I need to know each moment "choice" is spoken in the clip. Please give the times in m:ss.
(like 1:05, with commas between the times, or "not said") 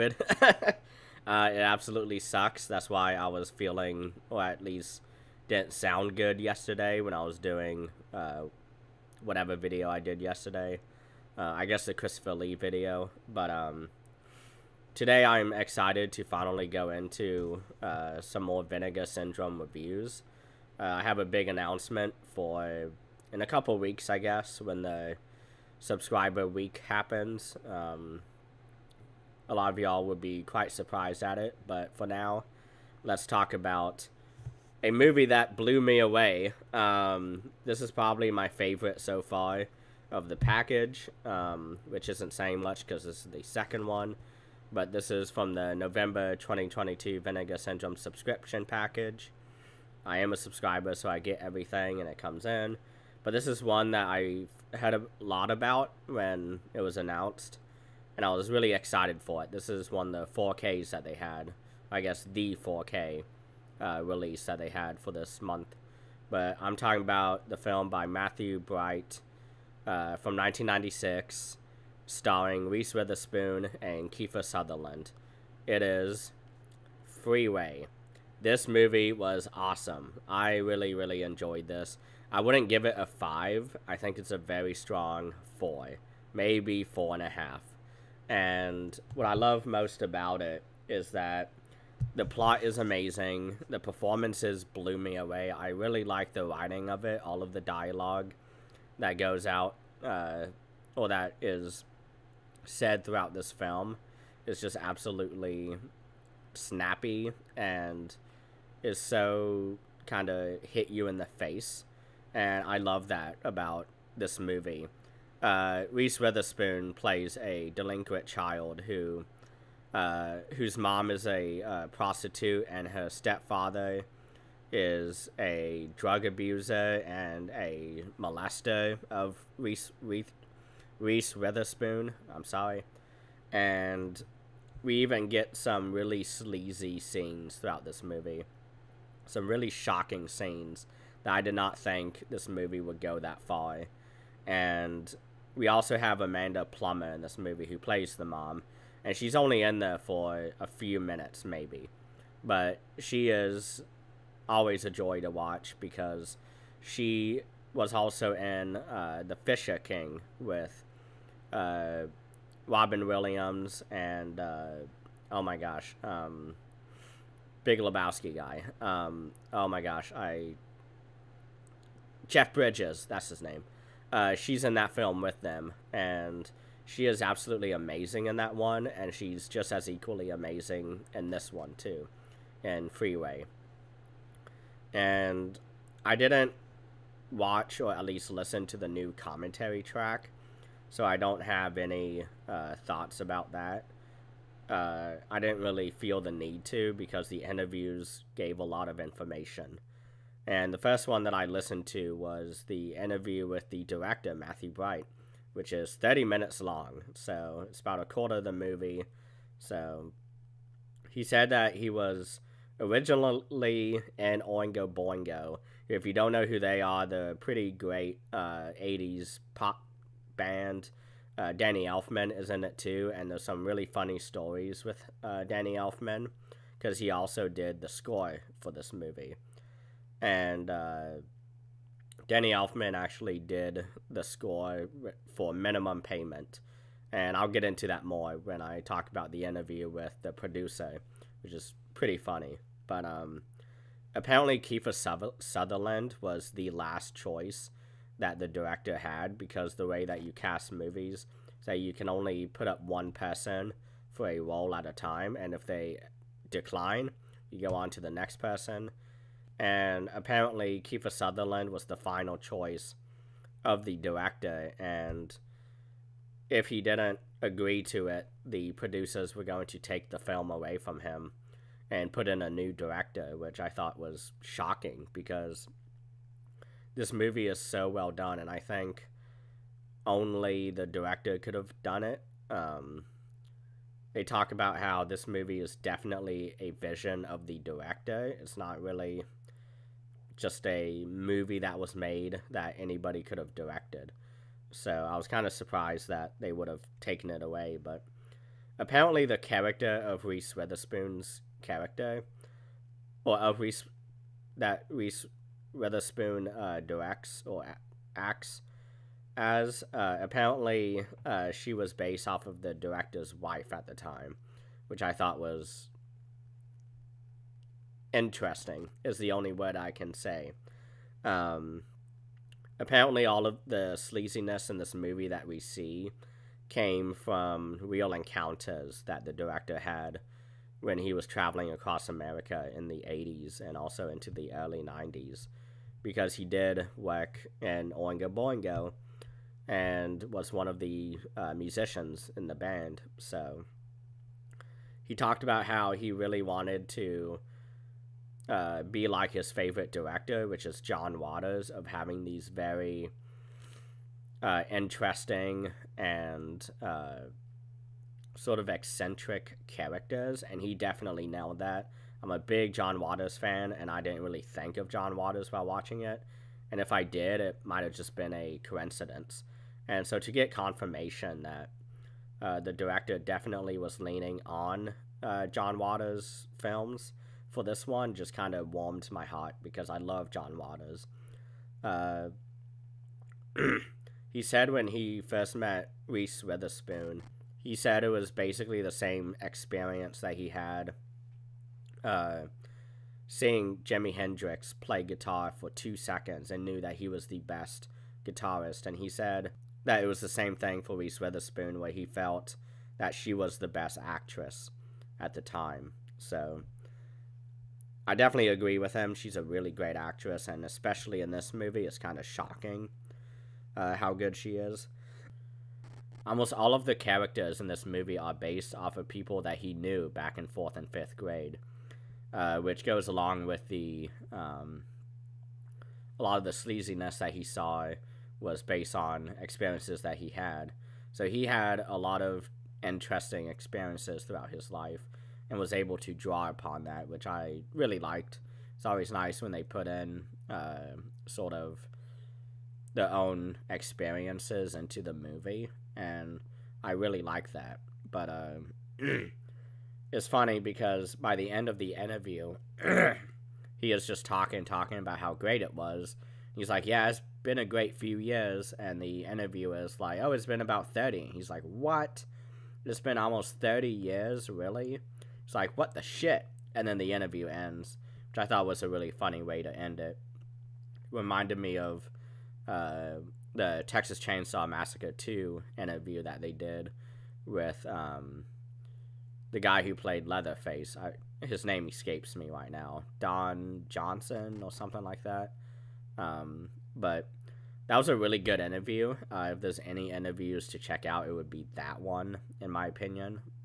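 4:07, 4:22.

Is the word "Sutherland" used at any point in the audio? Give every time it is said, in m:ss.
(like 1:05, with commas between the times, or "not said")
1:14, 4:05, 4:21.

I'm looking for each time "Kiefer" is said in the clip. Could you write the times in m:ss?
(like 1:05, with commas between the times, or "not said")
1:14, 4:04, 4:20.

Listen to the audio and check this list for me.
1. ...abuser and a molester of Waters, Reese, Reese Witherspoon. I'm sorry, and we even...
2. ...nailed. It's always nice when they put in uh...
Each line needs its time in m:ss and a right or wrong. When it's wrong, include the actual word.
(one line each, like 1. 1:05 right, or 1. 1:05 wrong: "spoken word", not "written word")
1. 2:06 wrong: "Reese", not "Waters"
2. 7:17 wrong: "liked", not "nailed".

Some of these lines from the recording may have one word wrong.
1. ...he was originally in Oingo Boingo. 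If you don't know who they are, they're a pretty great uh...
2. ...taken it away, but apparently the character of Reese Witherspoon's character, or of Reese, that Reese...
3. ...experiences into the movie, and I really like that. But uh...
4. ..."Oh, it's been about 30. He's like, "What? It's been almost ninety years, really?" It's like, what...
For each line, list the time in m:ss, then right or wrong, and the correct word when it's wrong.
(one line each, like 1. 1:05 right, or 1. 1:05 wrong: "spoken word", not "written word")
1. 3:31 right
2. 4:57 right
3. 7:23 right
4. 7:40 wrong: "thirty", not "ninety".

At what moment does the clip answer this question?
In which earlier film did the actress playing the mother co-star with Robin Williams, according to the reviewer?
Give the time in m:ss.
2:39.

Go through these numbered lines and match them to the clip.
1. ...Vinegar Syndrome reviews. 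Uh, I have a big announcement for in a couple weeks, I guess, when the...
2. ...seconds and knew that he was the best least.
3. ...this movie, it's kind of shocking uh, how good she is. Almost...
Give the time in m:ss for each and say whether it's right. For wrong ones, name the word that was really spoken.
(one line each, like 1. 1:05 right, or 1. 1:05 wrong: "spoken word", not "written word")
1. 0:18 right
2. 6:35 wrong: "guitarist", not "least"
3. 6:51 right.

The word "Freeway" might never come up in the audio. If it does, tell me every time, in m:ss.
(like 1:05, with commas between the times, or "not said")
1:17, 3:02.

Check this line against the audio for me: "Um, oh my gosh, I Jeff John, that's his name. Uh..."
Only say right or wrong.
wrong.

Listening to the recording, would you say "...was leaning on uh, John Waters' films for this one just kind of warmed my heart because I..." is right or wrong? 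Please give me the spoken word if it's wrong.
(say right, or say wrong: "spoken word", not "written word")
right.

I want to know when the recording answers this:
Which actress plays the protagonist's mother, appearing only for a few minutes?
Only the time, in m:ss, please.
2:26.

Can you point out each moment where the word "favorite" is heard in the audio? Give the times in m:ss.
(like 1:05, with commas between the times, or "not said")
0:38, 5:49.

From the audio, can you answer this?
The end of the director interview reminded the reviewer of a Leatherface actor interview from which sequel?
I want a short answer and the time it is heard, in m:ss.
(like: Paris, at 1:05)
Texas Chainsaw Massacre 2, at 7:53.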